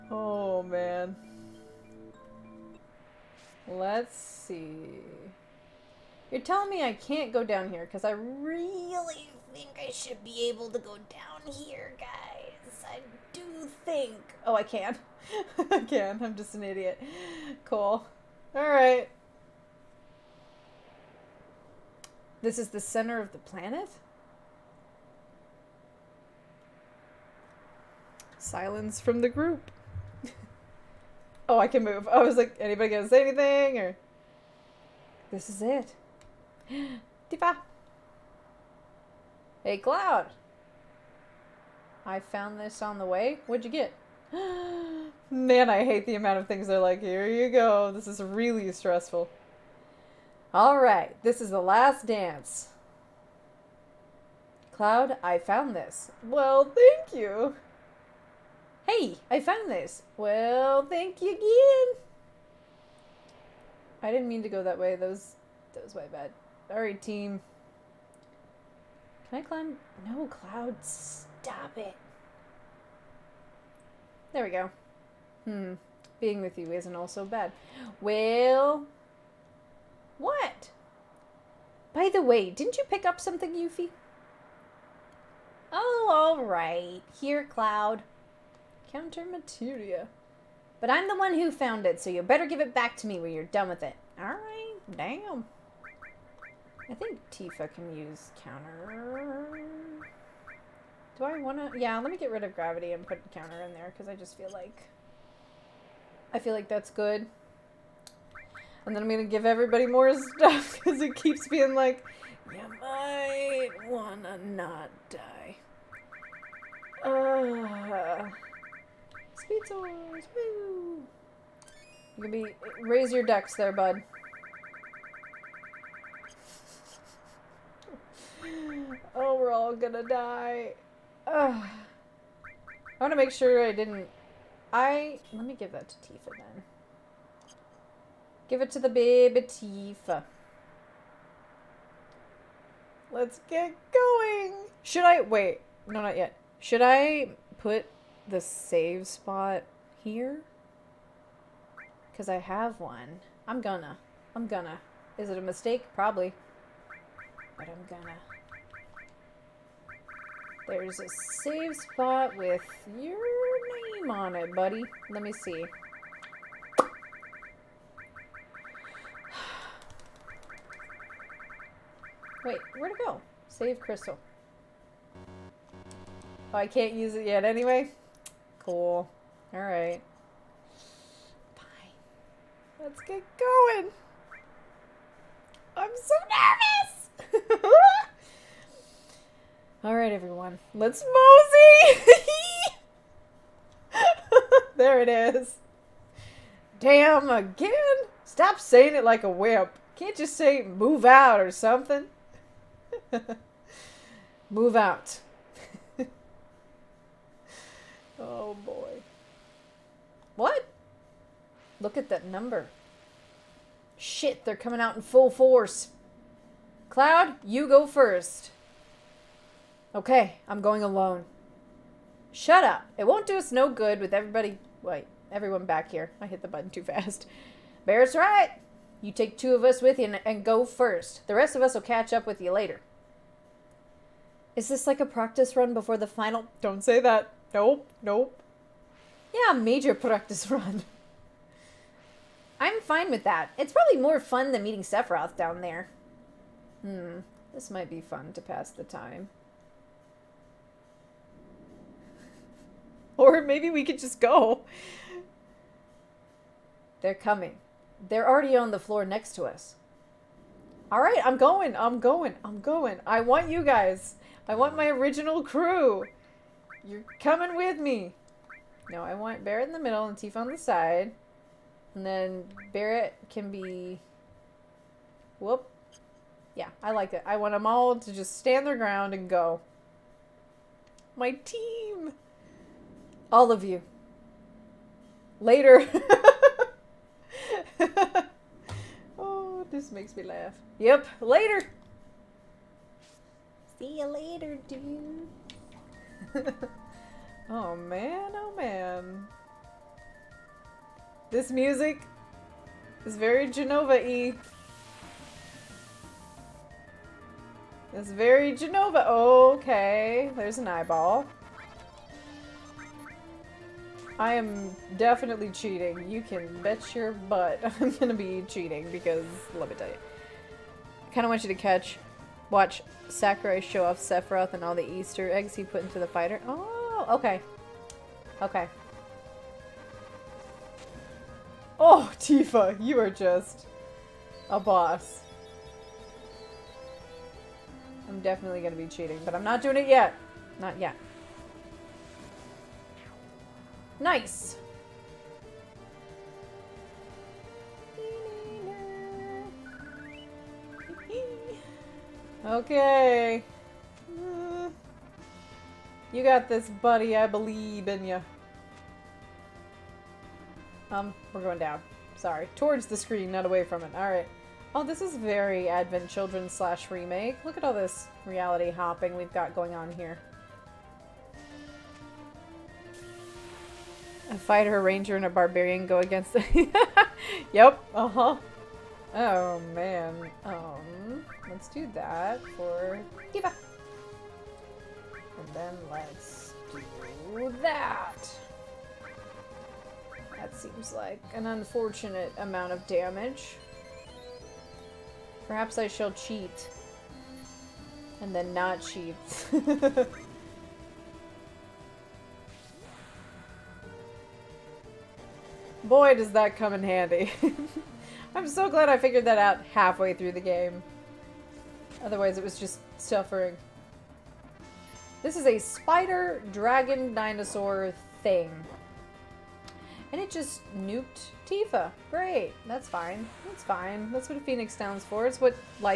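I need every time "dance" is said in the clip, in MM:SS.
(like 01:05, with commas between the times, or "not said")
00:52.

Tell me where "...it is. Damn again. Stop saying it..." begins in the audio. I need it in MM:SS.
03:15.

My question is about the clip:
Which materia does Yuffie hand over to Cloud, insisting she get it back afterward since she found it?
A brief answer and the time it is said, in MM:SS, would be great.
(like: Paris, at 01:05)
Counter materia, at 01:28.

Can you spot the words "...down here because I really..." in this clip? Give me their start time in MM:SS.
00:07.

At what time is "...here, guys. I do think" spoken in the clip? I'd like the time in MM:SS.
00:11.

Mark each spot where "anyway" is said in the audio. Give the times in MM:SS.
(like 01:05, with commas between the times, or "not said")
02:57.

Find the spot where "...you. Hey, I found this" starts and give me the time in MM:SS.
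00:57.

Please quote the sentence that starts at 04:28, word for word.
No, I want Barret in the middle and Tifa on the side.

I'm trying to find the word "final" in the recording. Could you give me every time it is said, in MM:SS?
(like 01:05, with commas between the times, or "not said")
03:56.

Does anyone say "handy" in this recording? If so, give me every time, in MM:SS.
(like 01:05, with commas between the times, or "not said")
06:46.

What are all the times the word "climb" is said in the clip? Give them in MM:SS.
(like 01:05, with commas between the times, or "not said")
01:09.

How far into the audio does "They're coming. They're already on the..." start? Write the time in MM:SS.
04:17.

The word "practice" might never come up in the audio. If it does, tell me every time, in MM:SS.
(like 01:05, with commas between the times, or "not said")
03:55, 03:59.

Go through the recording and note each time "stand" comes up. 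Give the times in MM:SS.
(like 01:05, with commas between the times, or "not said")
04:38, 07:04.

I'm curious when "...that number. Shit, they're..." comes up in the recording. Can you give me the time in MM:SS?
03:32.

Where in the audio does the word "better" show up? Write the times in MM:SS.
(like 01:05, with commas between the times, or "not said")
01:32.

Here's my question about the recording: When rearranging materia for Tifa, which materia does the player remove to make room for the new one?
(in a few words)
Gravity.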